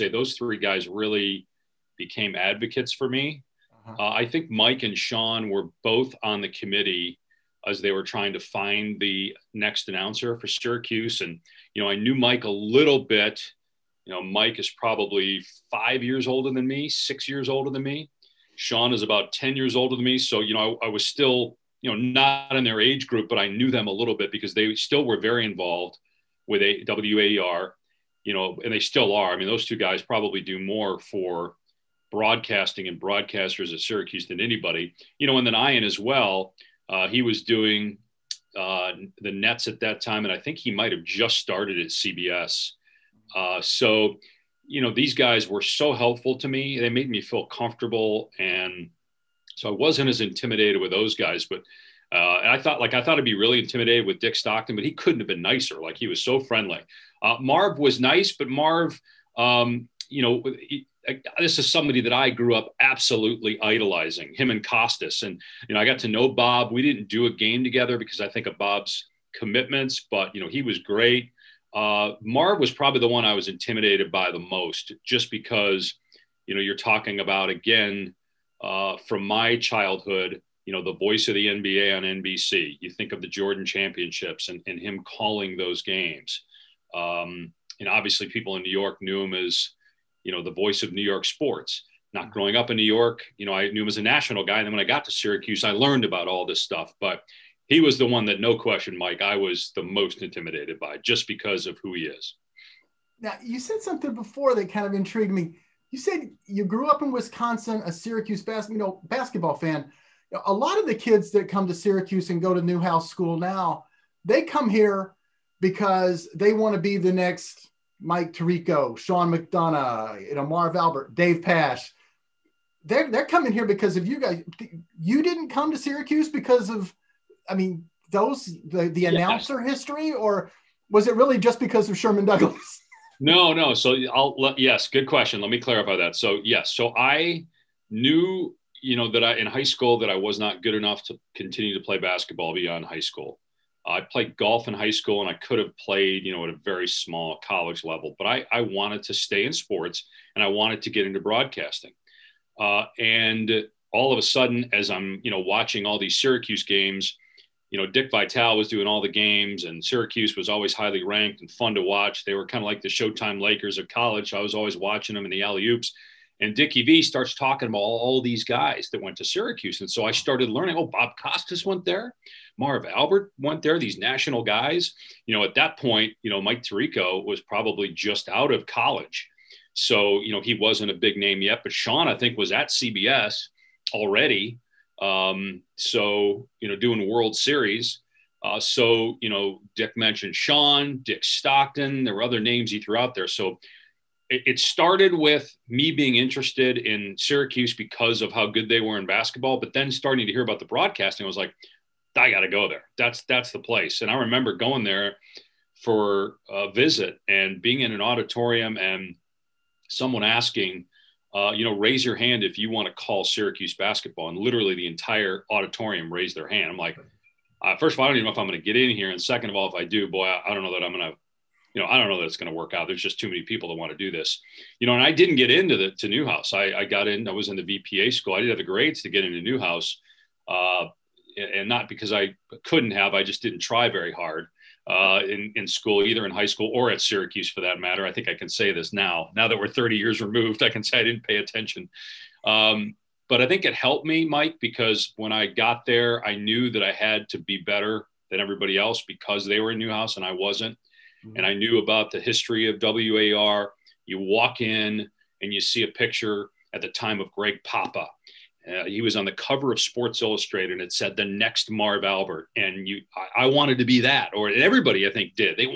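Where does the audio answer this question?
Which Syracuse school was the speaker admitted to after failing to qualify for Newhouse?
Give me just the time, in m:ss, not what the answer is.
3:47.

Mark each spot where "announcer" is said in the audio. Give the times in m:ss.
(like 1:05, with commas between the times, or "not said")
0:09, 2:09.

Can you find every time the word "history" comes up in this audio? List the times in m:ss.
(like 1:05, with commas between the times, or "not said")
2:09, 4:12.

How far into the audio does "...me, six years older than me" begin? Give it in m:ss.
0:16.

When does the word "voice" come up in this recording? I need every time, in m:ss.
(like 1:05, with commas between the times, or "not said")
1:20, 1:30.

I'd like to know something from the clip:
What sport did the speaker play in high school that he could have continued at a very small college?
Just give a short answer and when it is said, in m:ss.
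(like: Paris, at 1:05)
golf, at 2:24.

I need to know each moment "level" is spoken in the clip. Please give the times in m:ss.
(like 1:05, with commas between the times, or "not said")
2:27.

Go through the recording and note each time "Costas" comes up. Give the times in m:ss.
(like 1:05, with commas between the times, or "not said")
1:04, 2:51.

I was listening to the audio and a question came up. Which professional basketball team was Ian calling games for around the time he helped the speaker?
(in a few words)
the Nets.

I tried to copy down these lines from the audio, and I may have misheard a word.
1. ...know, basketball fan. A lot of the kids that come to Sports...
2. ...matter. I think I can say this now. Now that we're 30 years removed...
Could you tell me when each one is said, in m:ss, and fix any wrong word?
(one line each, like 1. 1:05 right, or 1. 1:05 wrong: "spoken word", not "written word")
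1. 1:48 wrong: "Syracuse", not "Sports"
2. 3:57 right.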